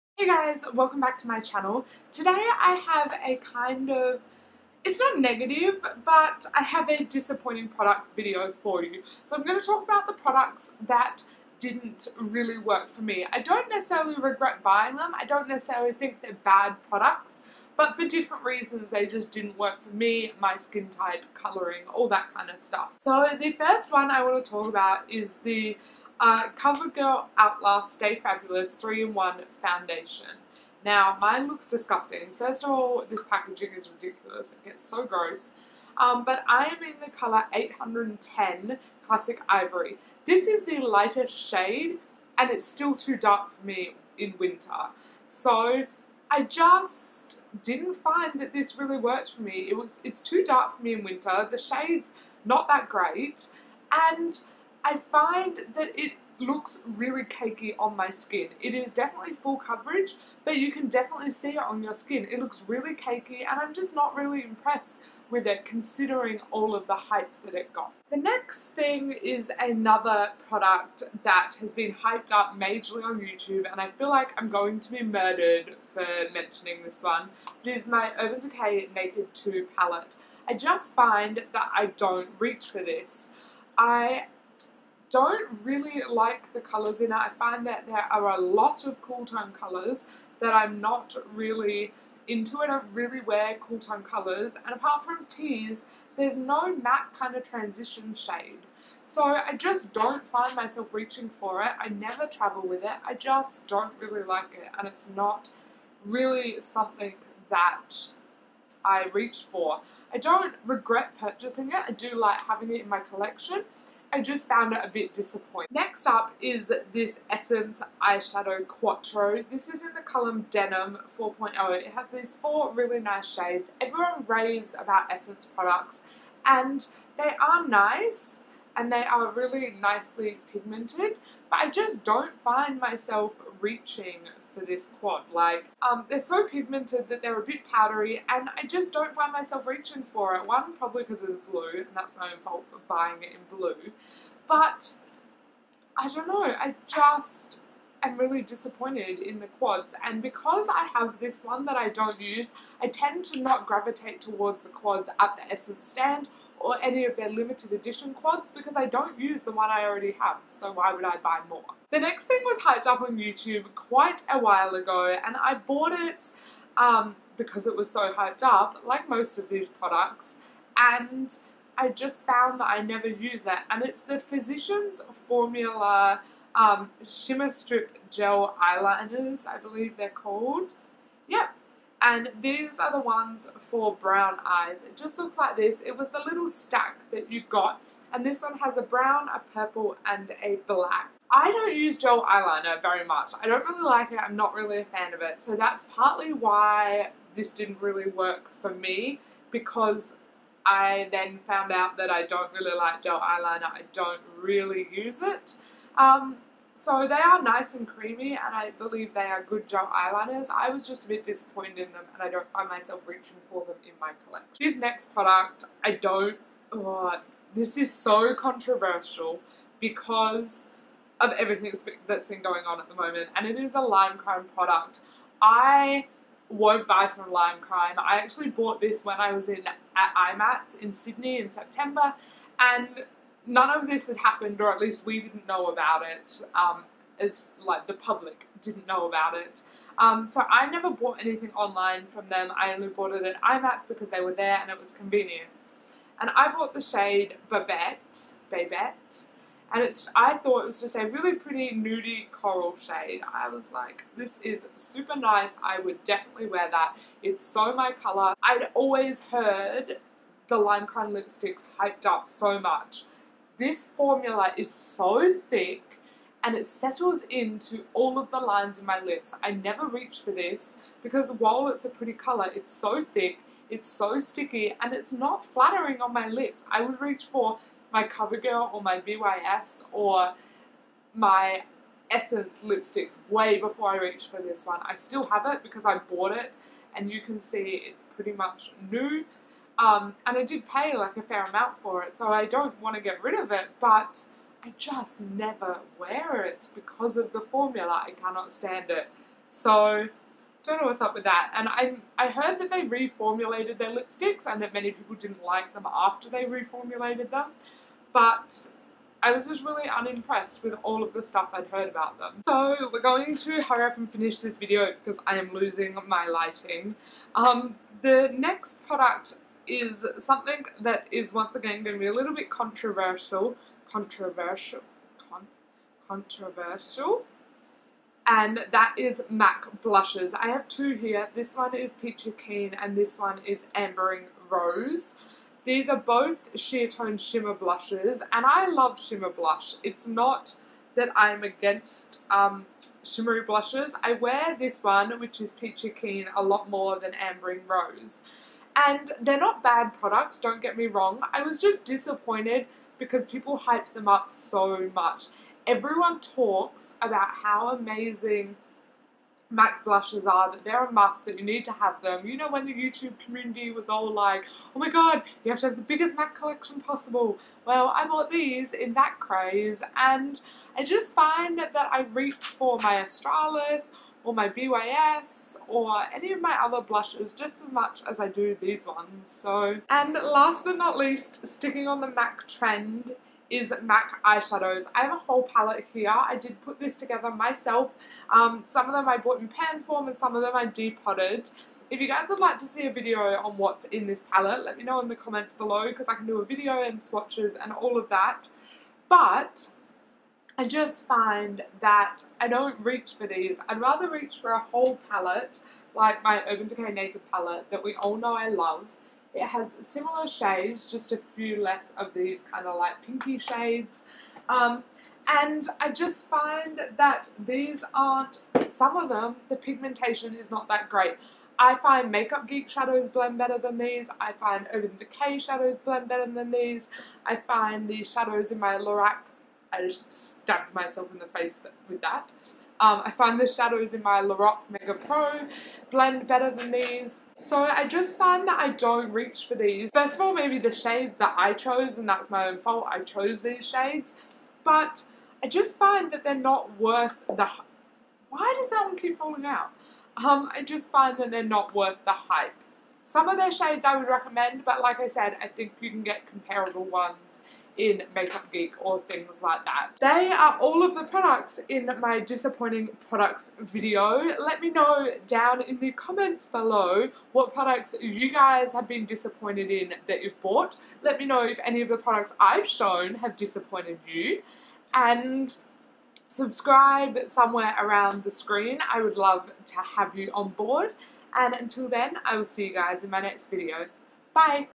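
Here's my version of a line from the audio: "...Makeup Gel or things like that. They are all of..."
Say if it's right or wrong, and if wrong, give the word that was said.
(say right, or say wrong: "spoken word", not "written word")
wrong: "Geek", not "Gel".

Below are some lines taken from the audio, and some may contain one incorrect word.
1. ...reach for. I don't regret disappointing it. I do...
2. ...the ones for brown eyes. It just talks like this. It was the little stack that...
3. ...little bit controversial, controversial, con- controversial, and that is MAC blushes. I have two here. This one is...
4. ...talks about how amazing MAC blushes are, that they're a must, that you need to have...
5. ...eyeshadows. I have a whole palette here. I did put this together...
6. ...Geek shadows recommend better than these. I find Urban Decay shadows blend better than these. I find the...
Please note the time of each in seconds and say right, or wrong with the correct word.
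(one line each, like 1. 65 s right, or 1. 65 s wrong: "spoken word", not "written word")
1. 109 s wrong: "purchasing", not "disappointing"
2. 182 s wrong: "looks", not "talks"
3. 322 s right
4. 356 s right
5. 384 s right
6. 422 s wrong: "blend", not "recommend".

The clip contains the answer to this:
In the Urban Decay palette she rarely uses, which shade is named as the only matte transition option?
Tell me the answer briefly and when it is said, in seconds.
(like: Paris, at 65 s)
Tease, at 95 s.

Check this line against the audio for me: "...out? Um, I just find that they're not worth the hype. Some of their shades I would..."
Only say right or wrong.
right.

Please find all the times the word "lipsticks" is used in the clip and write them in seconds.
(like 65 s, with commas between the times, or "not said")
261 s, 282 s, 303 s.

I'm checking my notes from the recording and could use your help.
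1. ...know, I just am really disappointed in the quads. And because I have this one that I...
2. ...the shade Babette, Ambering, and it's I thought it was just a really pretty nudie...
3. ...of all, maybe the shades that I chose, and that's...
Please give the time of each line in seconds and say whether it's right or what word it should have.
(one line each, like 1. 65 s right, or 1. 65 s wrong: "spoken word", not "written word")
1. 146 s right
2. 246 s wrong: "Babette", not "Ambering"
3. 440 s right.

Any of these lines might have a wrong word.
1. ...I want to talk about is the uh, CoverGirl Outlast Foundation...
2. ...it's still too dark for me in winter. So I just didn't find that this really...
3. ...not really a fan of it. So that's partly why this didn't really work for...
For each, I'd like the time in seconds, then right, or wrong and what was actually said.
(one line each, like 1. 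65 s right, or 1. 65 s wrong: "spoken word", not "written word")
1. 24 s wrong: "Stay", not "Foundation"
2. 42 s right
3. 194 s right.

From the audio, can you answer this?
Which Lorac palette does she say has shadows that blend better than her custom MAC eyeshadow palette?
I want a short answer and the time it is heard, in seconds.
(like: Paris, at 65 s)
Lorac Mega Pro, at 434 s.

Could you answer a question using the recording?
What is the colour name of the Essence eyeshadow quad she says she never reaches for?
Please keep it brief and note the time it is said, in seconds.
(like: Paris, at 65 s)
Denim 4.0, at 120 s.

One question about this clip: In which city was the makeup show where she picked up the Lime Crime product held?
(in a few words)
Sydney.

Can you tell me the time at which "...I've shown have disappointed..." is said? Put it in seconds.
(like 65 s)
472 s.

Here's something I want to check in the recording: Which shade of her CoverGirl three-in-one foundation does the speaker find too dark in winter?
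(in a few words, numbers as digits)
810 Classic Ivory.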